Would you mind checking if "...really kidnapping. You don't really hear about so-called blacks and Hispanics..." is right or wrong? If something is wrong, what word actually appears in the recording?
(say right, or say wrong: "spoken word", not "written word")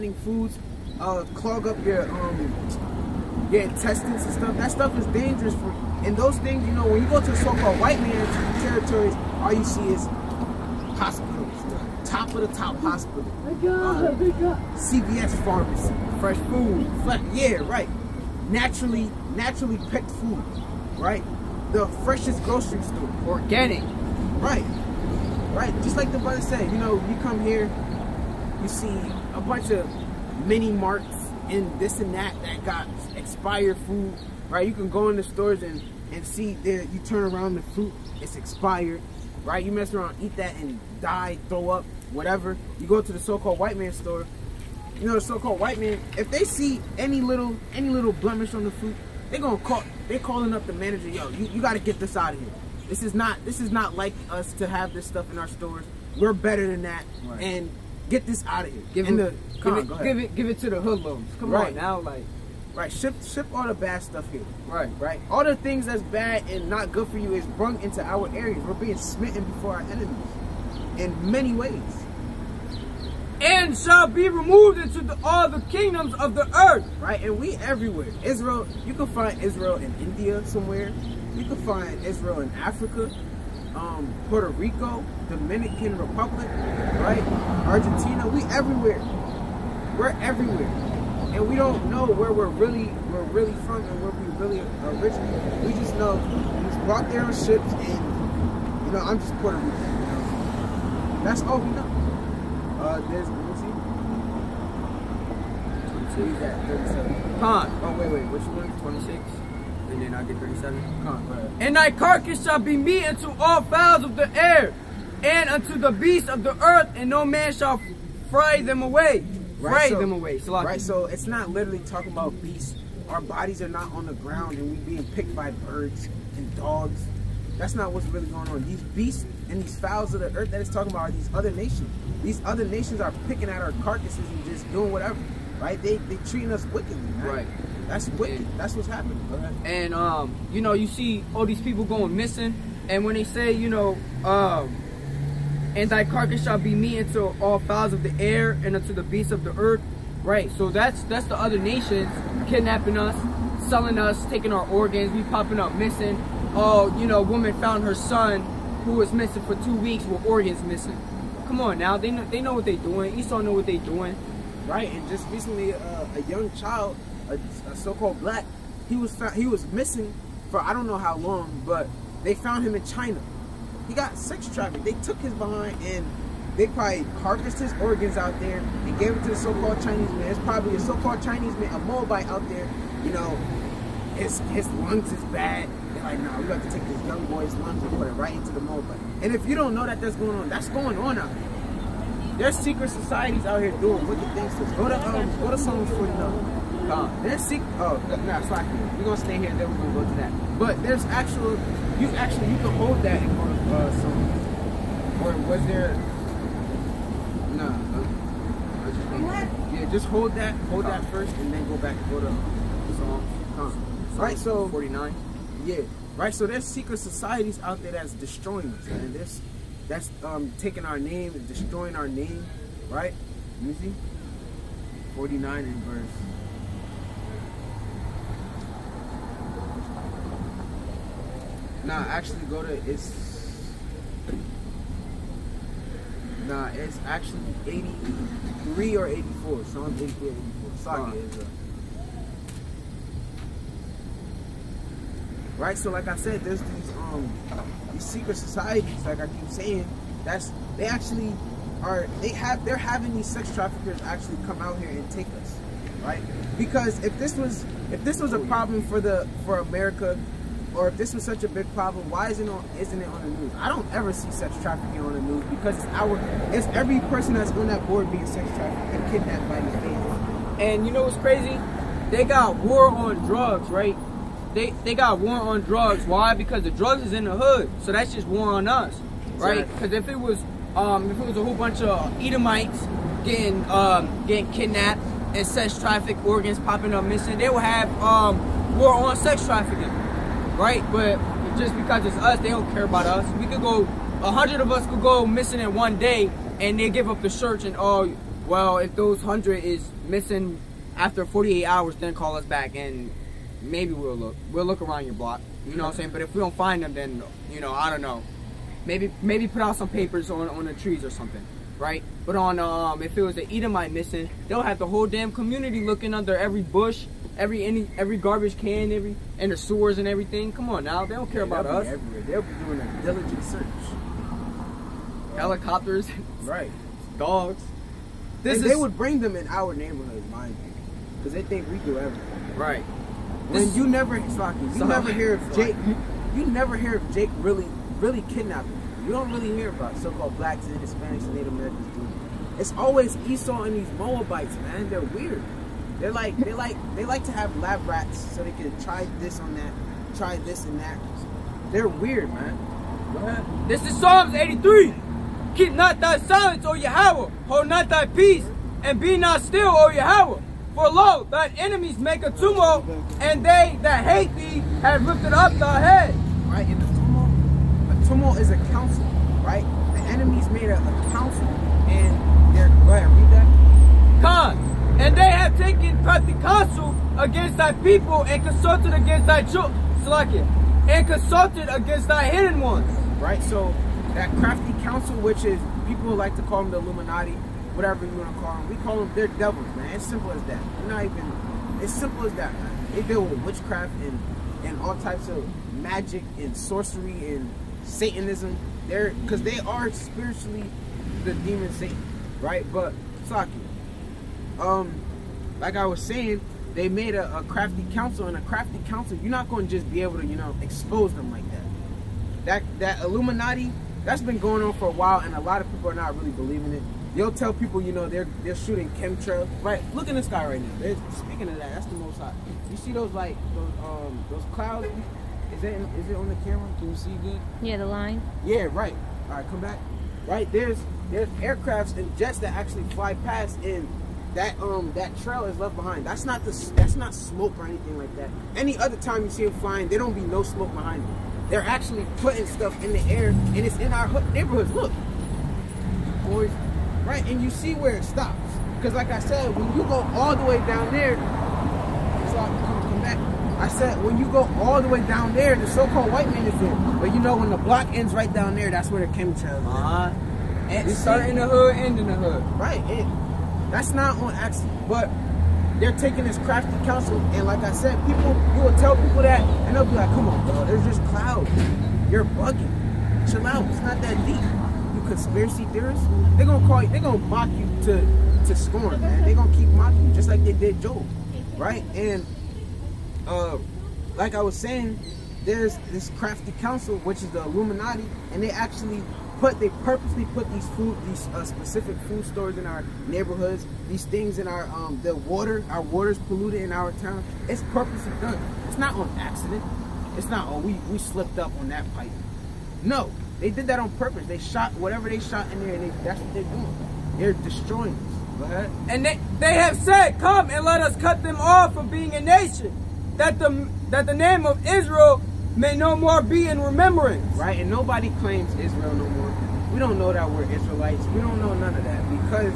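right.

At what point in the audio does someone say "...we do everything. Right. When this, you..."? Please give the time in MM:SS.
05:31.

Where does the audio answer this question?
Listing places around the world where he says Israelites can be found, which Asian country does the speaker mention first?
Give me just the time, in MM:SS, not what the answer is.
01:19.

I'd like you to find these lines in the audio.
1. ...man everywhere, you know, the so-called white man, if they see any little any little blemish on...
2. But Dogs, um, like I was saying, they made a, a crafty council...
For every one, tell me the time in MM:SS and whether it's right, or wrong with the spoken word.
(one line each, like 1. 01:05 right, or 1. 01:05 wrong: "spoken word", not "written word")
1. 00:43 wrong: "store", not "everywhere"
2. 06:42 wrong: "Saki", not "Dogs".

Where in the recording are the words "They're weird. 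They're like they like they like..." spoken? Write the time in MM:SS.
05:44.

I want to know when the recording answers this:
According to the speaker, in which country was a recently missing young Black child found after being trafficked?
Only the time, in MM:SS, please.
02:52.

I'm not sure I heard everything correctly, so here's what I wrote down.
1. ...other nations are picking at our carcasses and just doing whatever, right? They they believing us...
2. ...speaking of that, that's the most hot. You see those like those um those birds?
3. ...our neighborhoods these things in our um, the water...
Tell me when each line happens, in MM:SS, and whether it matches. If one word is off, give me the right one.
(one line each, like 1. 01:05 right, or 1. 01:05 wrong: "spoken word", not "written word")
1. 02:12 wrong: "treating", not "believing"
2. 07:01 wrong: "clouds", not "birds"
3. 08:12 right.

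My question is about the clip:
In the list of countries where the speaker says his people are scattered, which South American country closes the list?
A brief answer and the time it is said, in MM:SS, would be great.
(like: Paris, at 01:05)
Argentina, at 01:27.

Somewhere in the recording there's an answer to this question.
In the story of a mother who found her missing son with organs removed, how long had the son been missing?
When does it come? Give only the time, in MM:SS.
02:39.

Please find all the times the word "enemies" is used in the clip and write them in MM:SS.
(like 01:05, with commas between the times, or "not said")
01:09, 06:01, 06:10.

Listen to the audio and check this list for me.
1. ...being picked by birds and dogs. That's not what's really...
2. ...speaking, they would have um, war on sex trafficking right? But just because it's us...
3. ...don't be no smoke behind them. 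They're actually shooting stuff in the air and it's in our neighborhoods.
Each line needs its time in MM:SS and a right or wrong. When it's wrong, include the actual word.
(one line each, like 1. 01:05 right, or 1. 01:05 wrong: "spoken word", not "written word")
1. 02:04 right
2. 04:47 wrong: "missing", not "speaking"
3. 07:19 wrong: "putting", not "shooting".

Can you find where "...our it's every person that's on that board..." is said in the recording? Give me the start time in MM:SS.
04:25.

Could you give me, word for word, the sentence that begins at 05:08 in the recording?
Maybe maybe put out some papers on on the trees or something, right?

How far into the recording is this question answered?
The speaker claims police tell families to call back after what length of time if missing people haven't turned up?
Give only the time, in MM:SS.
05:01.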